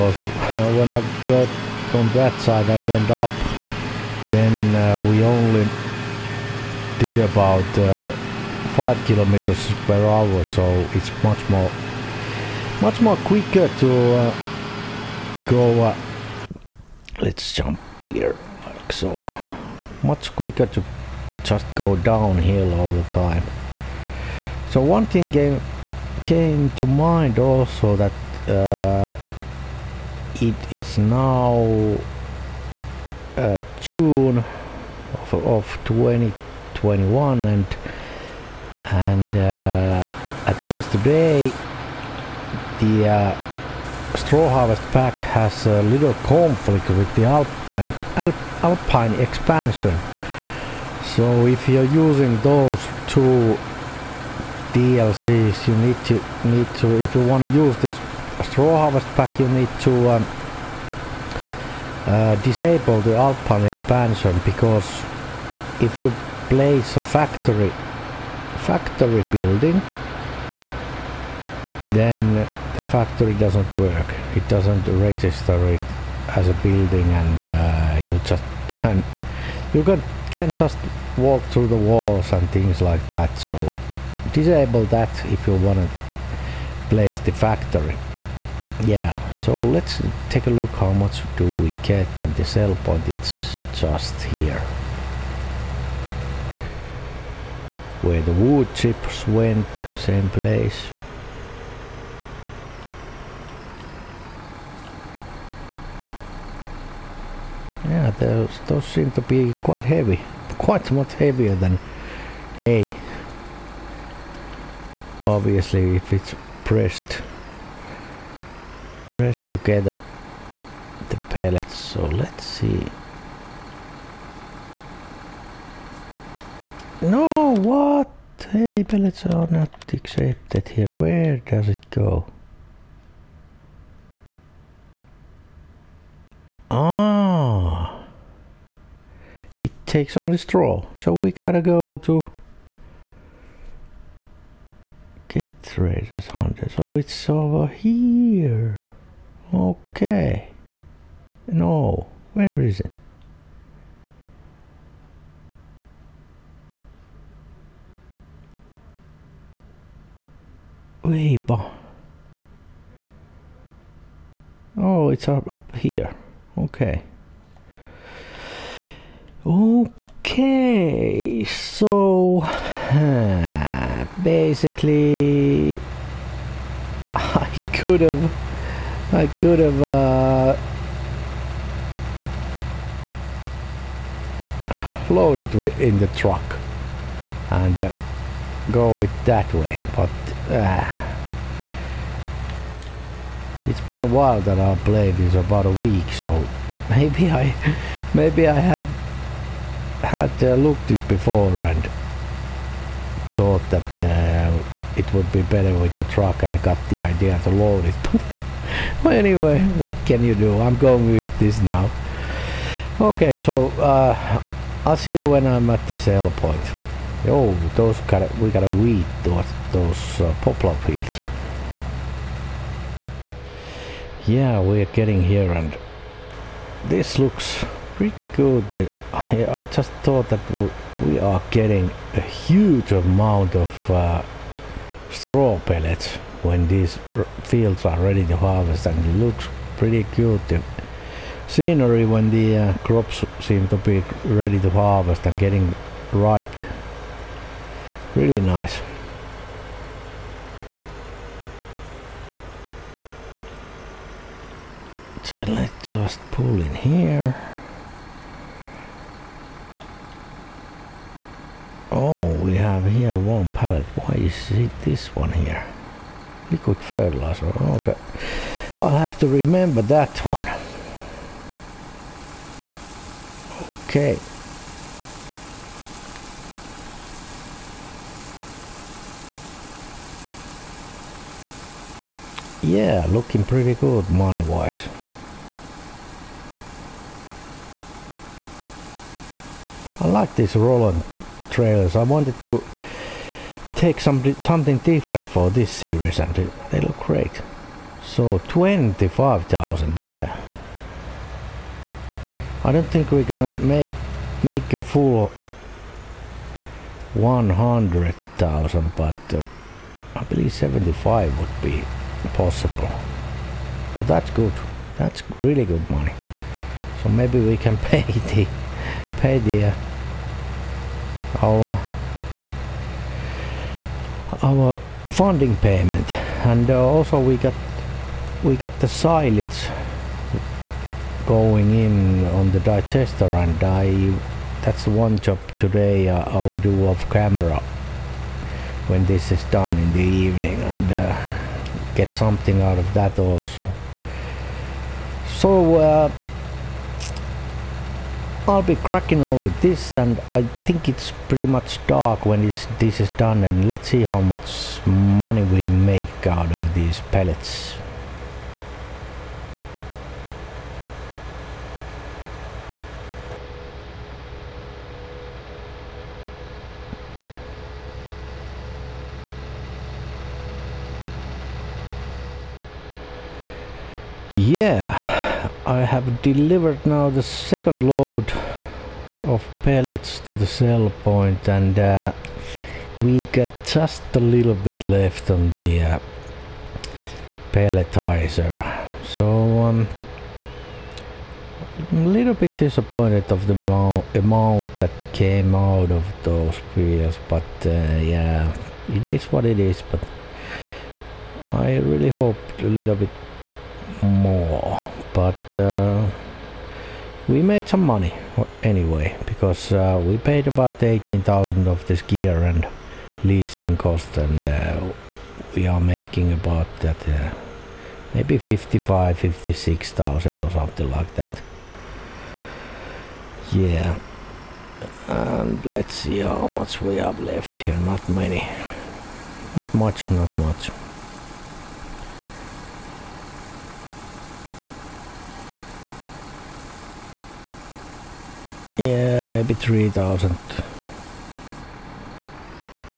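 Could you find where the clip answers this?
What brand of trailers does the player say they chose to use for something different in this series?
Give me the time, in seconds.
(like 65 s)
290 s.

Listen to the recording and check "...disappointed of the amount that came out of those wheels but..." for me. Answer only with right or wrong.
right.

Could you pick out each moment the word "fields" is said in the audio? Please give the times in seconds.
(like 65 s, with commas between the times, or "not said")
220 s, 237 s.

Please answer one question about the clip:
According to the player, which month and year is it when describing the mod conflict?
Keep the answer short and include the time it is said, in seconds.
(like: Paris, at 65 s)
June 2021, at 33 s.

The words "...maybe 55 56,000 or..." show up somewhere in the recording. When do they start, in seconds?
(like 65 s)
418 s.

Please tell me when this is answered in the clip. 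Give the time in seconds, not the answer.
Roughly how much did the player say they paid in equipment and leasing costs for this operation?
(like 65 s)
410 s.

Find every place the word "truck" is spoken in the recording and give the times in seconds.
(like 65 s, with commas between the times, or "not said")
186 s, 206 s.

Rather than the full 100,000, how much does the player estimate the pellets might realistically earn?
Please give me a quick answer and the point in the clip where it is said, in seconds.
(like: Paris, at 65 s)
75,000, at 310 s.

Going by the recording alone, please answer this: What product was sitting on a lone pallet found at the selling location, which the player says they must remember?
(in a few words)
Liquid fertilizer.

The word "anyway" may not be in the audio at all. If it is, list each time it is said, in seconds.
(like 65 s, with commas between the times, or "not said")
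209 s, 408 s.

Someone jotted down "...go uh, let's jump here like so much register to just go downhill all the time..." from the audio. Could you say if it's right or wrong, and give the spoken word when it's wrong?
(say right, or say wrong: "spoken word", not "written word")
wrong: "quicker", not "register".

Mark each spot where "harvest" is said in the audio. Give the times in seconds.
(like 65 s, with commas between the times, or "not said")
44 s, 58 s, 238 s, 244 s.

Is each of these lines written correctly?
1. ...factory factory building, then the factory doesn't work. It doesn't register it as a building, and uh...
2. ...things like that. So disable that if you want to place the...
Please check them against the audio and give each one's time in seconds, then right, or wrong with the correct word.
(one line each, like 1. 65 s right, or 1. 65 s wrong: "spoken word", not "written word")
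1. 67 s right
2. 82 s right.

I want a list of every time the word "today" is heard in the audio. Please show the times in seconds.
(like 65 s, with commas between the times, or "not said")
40 s, 335 s.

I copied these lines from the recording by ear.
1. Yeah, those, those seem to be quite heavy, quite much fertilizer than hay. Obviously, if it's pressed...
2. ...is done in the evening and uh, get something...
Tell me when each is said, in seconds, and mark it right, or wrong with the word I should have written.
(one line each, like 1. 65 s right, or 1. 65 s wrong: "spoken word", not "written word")
1. 107 s wrong: "heavier", not "fertilizer"
2. 339 s right.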